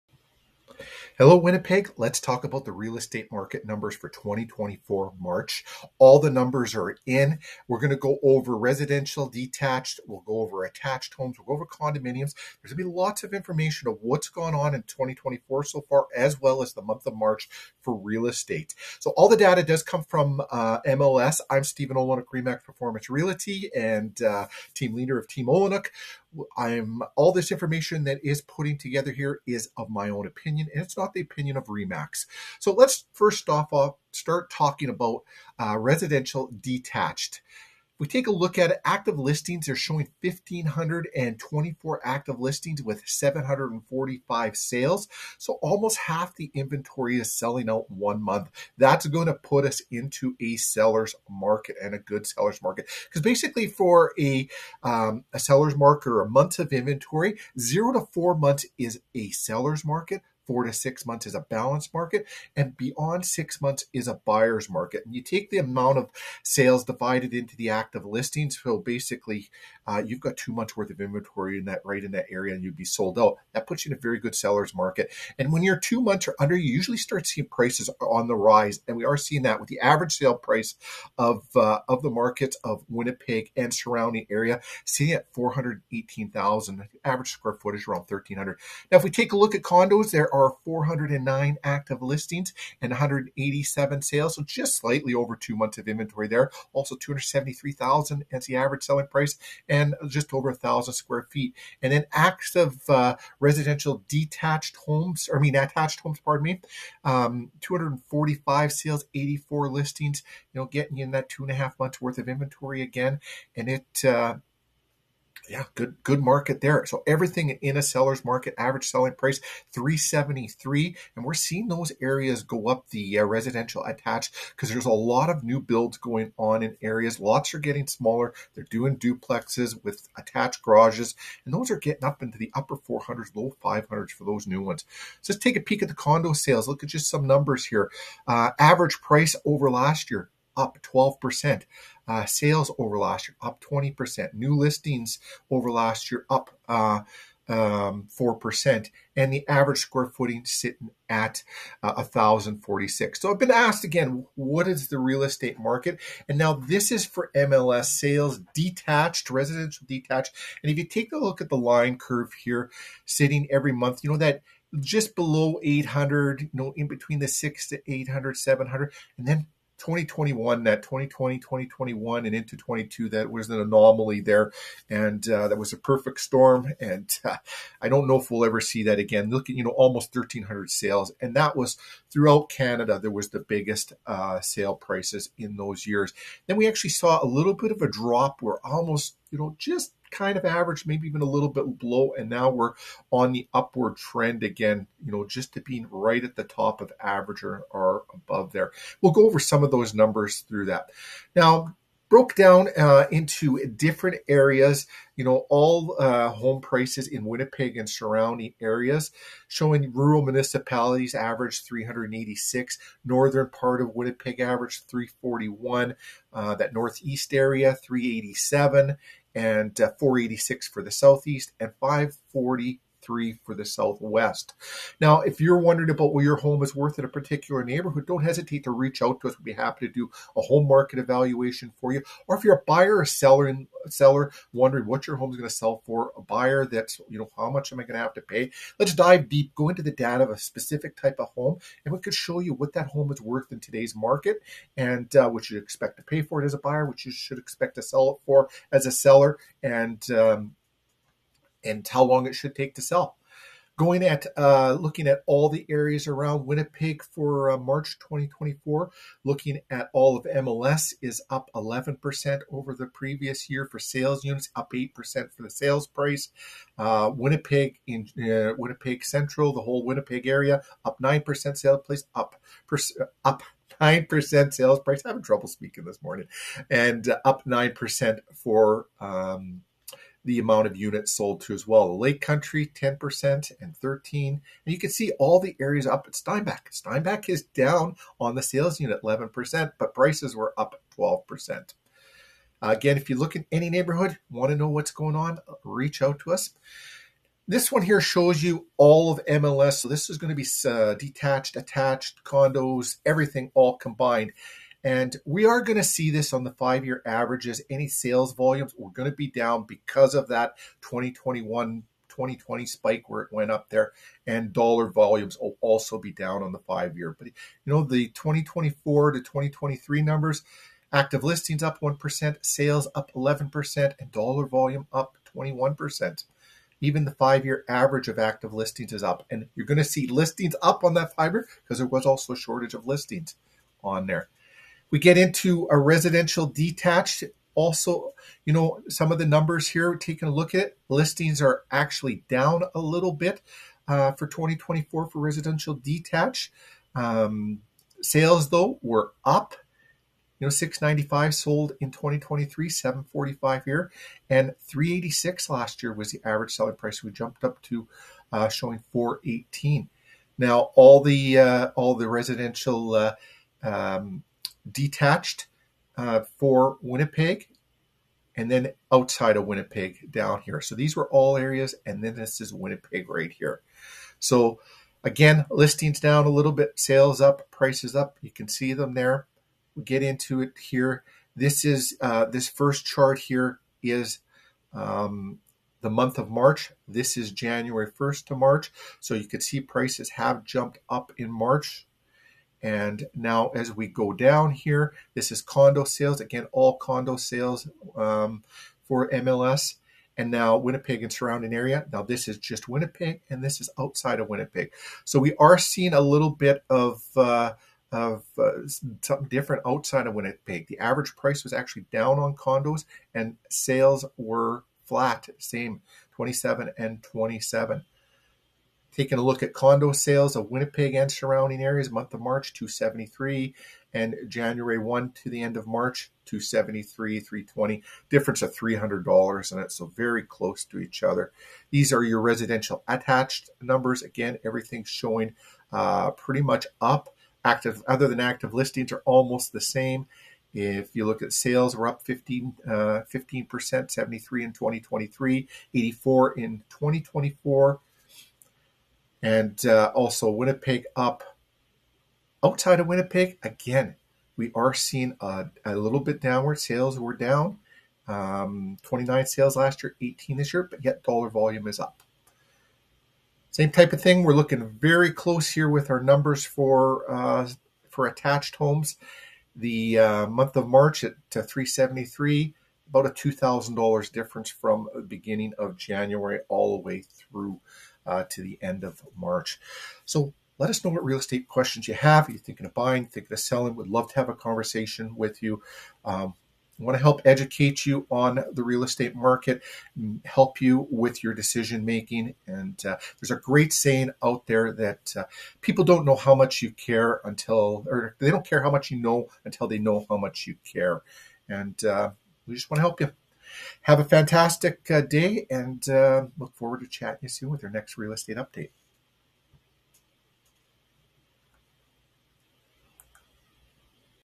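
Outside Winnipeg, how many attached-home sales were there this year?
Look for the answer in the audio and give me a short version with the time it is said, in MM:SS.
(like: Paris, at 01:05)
18, at 07:40.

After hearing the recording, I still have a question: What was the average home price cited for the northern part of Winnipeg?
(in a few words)
341,000.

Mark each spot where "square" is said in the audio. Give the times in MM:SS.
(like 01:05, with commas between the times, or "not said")
01:27, 01:40, 02:29.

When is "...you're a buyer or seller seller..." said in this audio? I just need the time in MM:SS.
03:52.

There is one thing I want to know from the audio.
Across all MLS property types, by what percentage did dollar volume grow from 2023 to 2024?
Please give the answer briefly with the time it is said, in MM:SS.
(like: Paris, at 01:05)
21%, at 05:24.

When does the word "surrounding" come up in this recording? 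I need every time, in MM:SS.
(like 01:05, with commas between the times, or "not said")
01:23, 03:27, 06:41, 07:01.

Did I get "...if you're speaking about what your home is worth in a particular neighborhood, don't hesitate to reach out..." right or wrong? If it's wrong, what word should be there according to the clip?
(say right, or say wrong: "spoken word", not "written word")
wrong: "wondering", not "speaking".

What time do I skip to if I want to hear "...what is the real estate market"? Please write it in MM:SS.
02:34.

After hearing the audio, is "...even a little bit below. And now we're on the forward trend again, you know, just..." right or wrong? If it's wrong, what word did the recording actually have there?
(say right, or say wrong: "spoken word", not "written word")
wrong: "upward", not "forward".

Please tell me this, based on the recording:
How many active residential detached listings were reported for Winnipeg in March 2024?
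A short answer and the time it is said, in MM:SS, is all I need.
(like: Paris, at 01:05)
1,524, at 00:40.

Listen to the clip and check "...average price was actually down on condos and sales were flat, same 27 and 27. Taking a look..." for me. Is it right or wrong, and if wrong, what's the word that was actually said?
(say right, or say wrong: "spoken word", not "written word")
right.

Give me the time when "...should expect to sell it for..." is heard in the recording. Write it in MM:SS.
04:07.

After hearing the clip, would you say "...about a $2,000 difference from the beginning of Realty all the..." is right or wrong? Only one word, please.
wrong.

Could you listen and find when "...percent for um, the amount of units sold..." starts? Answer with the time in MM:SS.
04:37.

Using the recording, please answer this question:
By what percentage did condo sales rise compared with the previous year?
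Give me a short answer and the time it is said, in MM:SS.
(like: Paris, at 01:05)
20%, at 02:23.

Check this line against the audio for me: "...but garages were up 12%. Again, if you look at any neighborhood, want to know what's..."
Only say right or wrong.
wrong.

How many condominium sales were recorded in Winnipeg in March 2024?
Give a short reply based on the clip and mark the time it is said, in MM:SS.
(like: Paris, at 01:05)
187, at 01:32.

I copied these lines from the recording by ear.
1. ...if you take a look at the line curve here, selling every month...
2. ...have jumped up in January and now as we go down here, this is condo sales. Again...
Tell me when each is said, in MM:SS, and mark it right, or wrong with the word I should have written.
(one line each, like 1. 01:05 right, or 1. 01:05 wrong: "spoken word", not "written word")
1. 02:40 wrong: "sitting", not "selling"
2. 06:30 wrong: "March", not "January".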